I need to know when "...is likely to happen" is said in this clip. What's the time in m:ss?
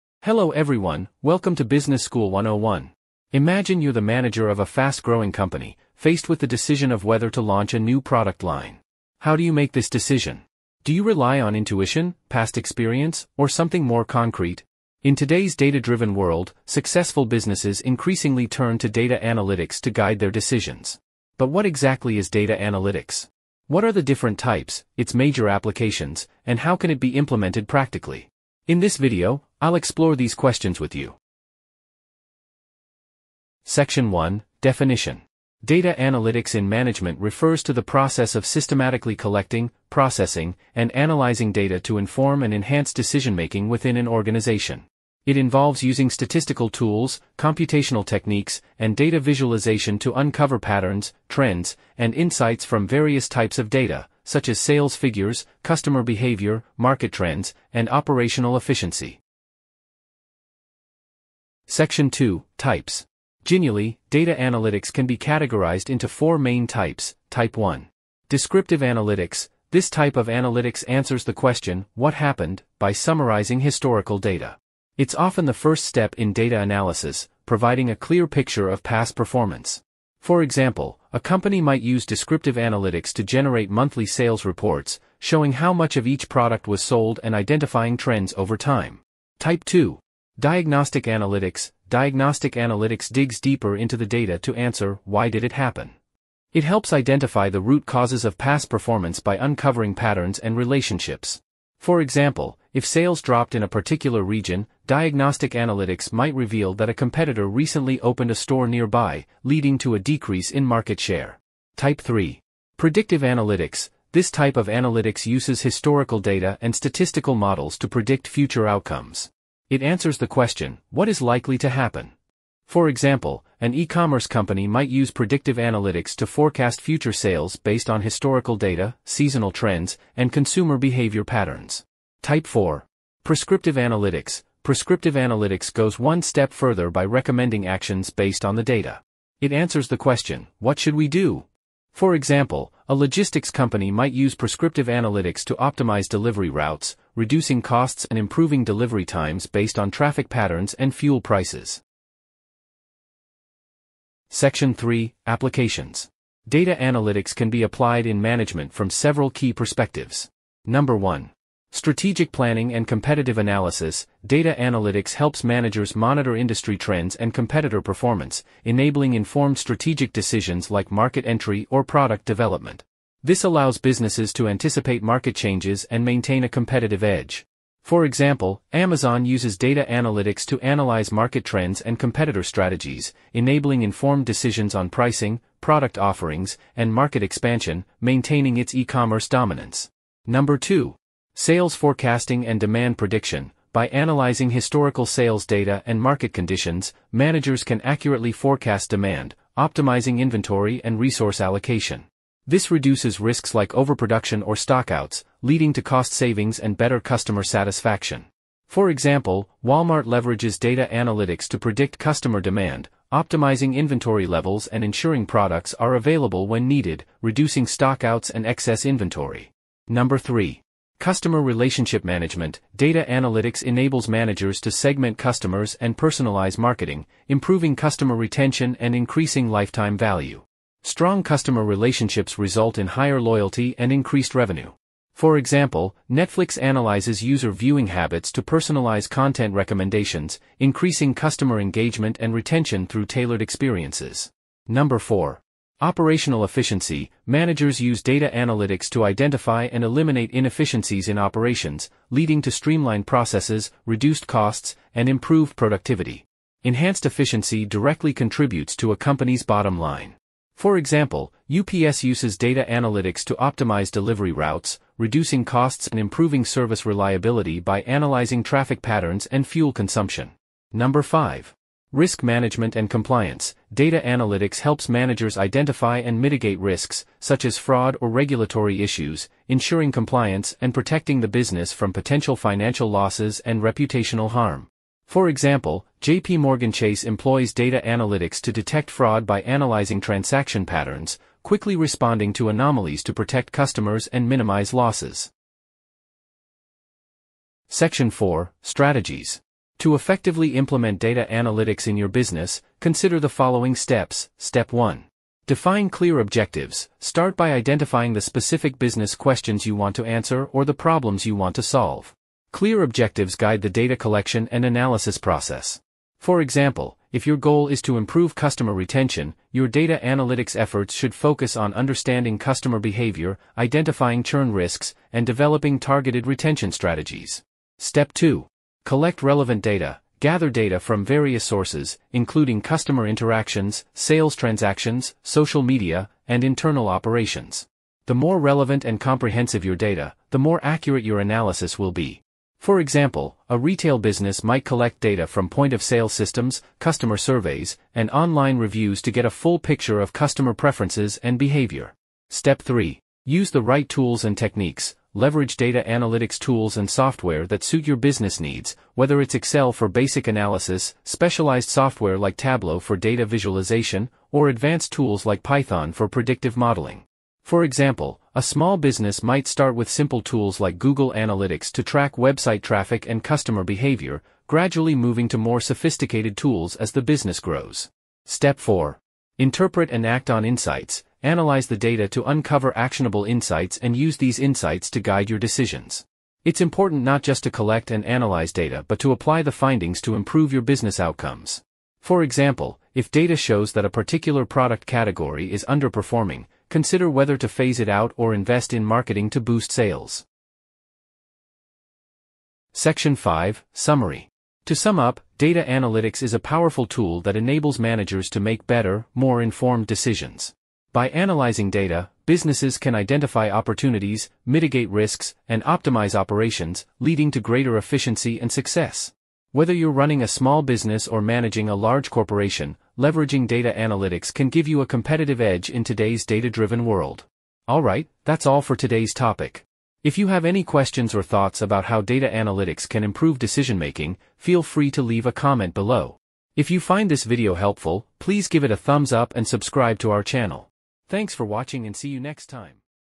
2:01.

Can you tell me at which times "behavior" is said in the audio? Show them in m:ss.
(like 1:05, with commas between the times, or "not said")
0:56, 2:10, 5:22, 5:51, 6:13.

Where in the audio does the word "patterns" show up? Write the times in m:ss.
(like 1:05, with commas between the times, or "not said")
0:50, 1:39, 2:11, 2:30, 4:28, 4:50.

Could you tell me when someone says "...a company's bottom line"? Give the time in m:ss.
4:18.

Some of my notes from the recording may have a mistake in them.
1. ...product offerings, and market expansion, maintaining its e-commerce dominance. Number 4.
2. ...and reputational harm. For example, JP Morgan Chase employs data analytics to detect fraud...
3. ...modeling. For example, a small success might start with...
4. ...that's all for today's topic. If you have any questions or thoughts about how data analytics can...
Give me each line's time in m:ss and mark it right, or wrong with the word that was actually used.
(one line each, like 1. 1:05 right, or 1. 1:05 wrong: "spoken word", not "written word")
1. 3:05 wrong: "2", not "4"
2. 4:43 right
3. 6:06 wrong: "business", not "success"
4. 7:08 right.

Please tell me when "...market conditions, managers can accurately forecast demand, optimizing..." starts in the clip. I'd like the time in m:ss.
3:16.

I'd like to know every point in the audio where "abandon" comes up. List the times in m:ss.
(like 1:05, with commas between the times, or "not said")
not said.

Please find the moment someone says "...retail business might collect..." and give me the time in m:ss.
5:43.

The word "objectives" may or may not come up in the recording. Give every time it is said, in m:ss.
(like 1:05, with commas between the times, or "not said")
5:06, 5:12.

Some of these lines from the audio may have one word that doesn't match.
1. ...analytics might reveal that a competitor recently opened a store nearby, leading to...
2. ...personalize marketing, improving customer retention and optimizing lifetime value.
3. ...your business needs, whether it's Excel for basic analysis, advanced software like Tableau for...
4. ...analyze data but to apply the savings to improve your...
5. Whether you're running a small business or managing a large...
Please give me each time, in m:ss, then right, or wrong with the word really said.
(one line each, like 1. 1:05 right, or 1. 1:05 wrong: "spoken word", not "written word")
1. 1:45 right
2. 3:45 wrong: "increasing", not "optimizing"
3. 5:57 wrong: "specialized", not "advanced"
4. 6:28 wrong: "findings", not "savings"
5. 6:59 right.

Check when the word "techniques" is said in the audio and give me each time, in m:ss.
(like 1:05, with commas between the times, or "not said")
0:48, 5:54.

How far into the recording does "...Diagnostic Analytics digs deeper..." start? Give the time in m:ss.
1:31.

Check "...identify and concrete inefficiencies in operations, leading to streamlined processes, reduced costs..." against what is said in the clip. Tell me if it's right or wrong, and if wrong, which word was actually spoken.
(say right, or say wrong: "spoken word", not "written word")
wrong: "eliminate", not "concrete".